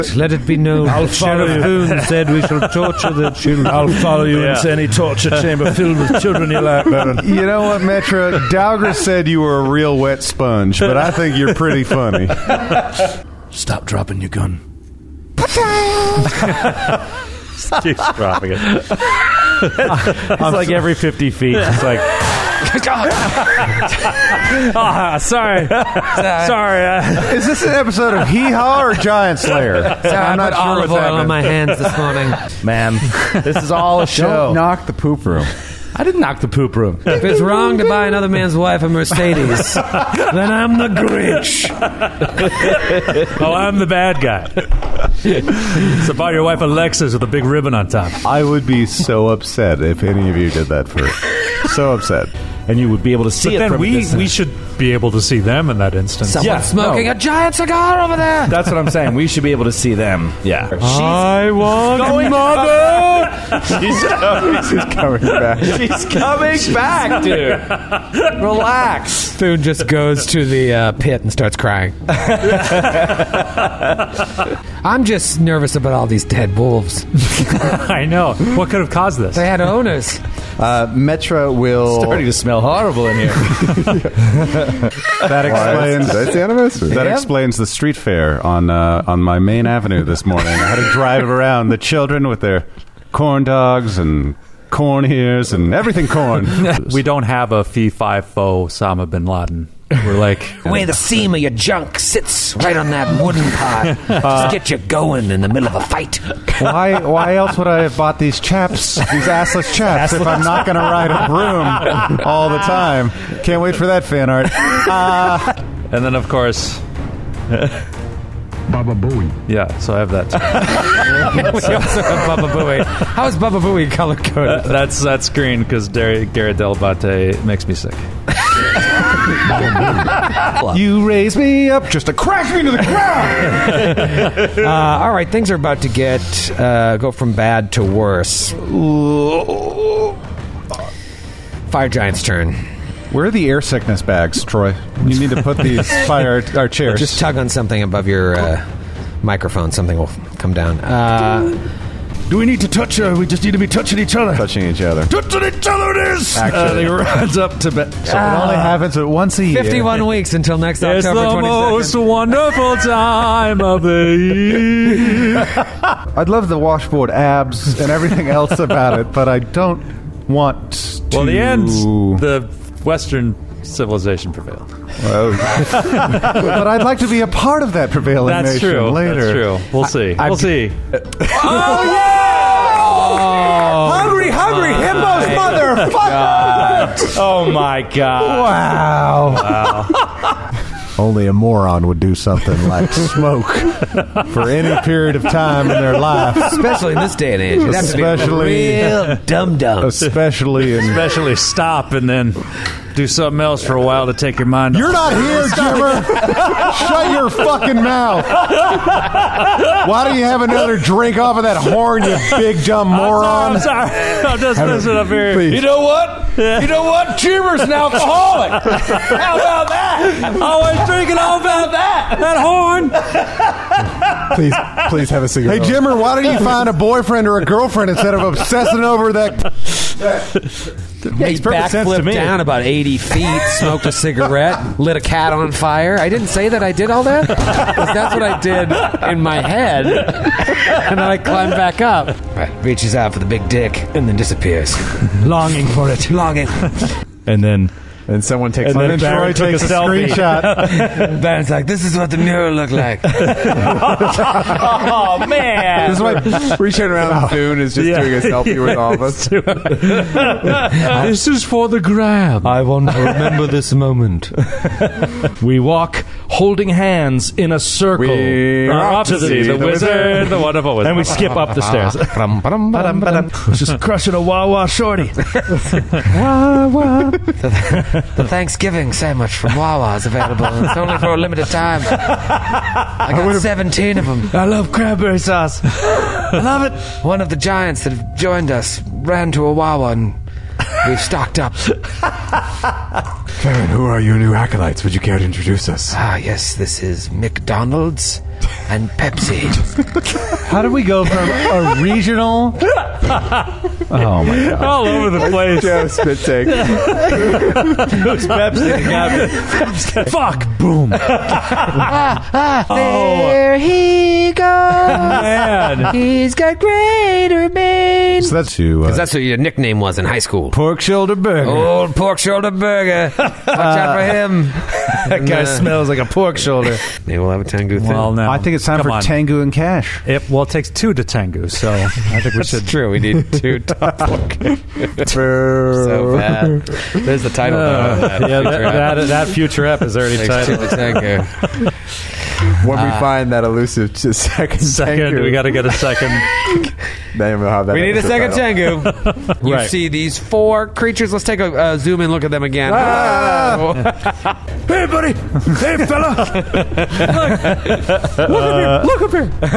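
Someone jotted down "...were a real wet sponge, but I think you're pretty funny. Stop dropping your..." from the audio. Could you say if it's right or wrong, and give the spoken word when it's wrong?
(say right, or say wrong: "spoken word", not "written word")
right.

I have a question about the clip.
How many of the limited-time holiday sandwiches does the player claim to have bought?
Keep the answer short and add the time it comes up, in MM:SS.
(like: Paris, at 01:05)
17, at 04:43.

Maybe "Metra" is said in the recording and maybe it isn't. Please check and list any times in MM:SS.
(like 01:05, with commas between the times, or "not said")
00:07, 01:20.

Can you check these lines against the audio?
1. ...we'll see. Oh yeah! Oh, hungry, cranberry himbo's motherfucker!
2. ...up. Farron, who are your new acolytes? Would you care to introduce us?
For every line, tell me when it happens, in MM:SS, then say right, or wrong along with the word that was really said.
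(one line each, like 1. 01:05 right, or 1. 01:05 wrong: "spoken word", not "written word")
1. 03:00 wrong: "hungry", not "cranberry"
2. 04:51 right.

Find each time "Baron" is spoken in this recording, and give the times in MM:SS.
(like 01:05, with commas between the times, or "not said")
00:06, 04:11.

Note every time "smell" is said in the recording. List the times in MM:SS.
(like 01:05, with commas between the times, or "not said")
01:22, 05:25.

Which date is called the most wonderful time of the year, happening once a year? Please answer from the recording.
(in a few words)
October 22nd.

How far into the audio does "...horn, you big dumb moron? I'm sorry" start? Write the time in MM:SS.
03:31.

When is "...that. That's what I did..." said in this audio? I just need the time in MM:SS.
03:57.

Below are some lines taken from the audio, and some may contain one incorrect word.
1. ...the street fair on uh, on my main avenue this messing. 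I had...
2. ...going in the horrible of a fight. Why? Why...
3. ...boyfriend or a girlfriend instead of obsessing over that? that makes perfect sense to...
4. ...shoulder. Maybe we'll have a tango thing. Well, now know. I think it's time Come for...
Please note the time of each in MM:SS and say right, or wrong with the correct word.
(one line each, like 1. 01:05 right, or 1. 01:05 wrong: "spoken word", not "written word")
1. 01:27 wrong: "morning", not "messing"
2. 01:44 wrong: "middle", not "horrible"
3. 03:46 right
4. 05:26 right.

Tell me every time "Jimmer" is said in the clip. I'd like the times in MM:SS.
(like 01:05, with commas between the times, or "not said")
03:25, 03:45.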